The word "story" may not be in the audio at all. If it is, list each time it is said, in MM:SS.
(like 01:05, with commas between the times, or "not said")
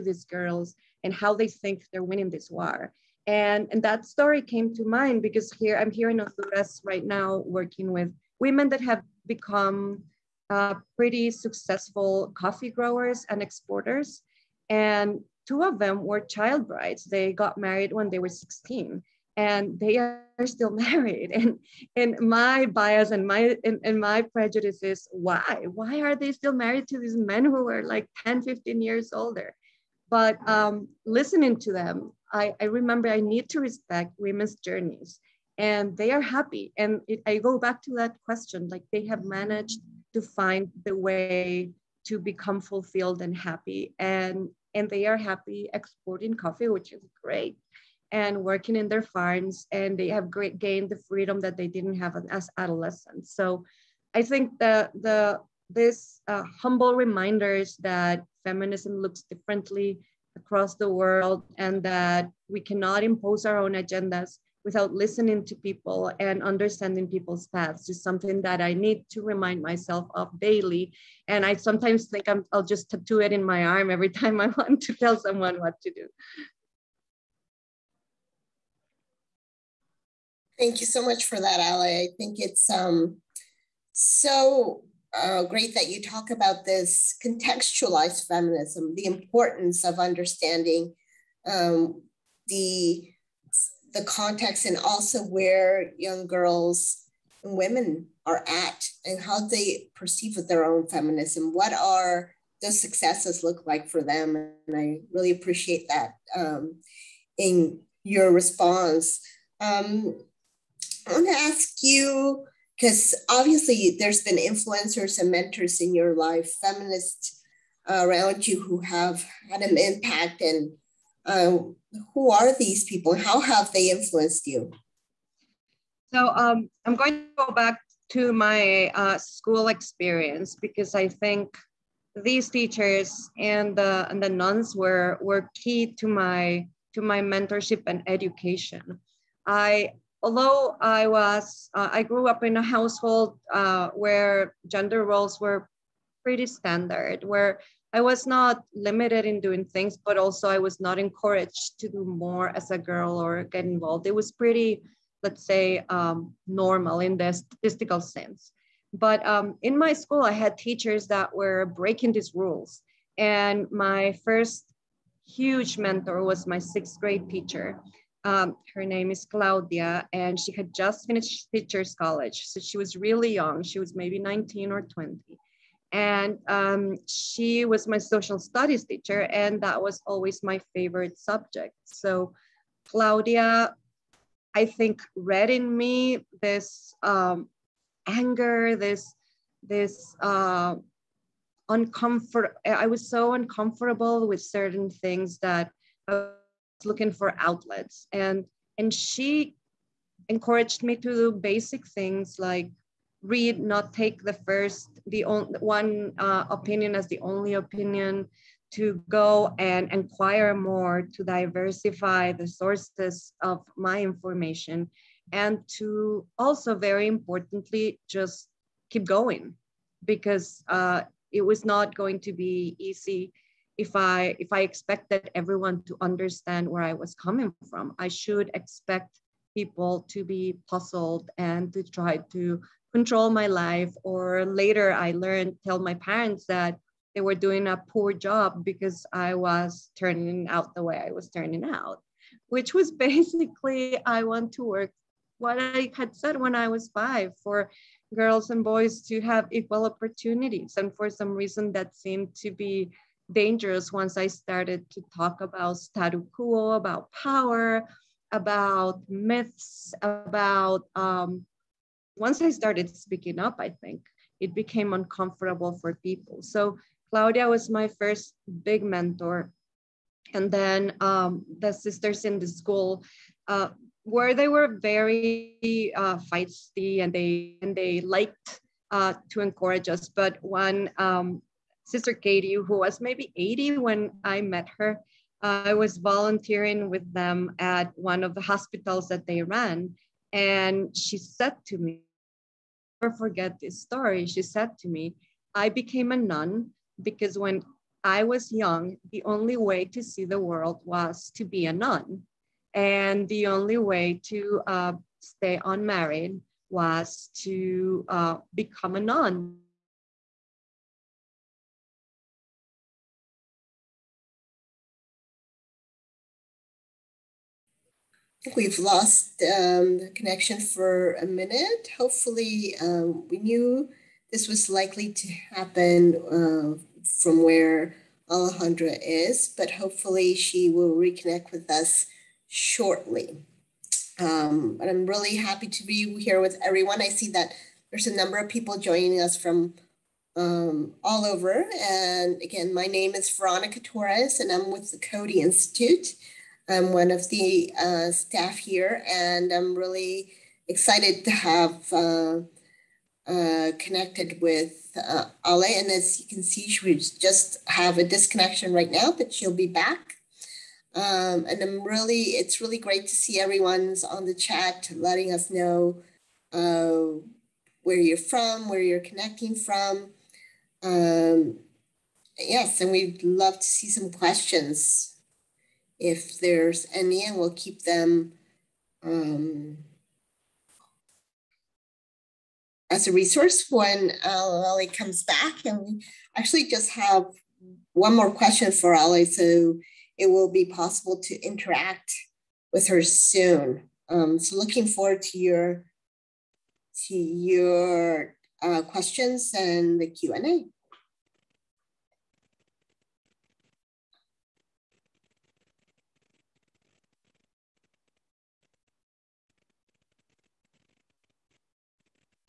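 00:04, 04:53.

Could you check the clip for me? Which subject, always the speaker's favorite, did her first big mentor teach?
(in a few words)
Social studies.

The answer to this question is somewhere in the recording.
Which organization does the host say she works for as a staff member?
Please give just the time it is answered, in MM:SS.
05:44.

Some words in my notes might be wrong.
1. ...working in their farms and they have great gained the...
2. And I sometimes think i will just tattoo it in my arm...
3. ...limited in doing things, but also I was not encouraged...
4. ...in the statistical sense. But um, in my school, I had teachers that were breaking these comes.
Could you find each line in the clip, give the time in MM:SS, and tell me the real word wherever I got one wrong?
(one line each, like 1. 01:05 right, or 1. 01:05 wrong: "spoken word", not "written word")
1. 00:48 right
2. 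01:11 right
3. 02:28 right
4. 02:36 wrong: "rules", not "comes".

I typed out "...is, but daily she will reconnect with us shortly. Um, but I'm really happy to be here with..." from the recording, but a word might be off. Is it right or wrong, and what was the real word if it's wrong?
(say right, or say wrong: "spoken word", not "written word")
wrong: "hopefully", not "daily".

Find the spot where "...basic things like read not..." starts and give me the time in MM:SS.
03:21.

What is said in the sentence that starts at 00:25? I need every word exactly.
Why are they still married to these men who are like 10, 15 years older?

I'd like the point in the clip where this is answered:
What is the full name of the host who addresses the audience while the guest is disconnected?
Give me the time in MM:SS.
05:43.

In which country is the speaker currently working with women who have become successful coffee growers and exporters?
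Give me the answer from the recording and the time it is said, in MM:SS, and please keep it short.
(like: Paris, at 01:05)
Honduras, at 00:06.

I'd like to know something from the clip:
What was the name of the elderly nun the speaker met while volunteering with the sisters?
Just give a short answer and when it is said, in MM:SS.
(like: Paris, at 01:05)
Sister Katie, at 04:41.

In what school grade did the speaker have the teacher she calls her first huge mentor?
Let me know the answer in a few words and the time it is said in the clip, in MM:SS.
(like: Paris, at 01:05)
Sixth grade, at 02:46.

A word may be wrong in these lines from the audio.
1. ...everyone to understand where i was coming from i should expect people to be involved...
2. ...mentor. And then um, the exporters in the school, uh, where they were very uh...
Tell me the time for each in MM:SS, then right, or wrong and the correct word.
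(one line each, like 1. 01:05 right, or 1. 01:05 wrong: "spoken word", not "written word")
1. 03:45 wrong: "puzzled", not "involved"
2. 04:28 wrong: "sisters", not "exporters".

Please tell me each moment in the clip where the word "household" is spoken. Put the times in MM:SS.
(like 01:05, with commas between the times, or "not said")
02:22.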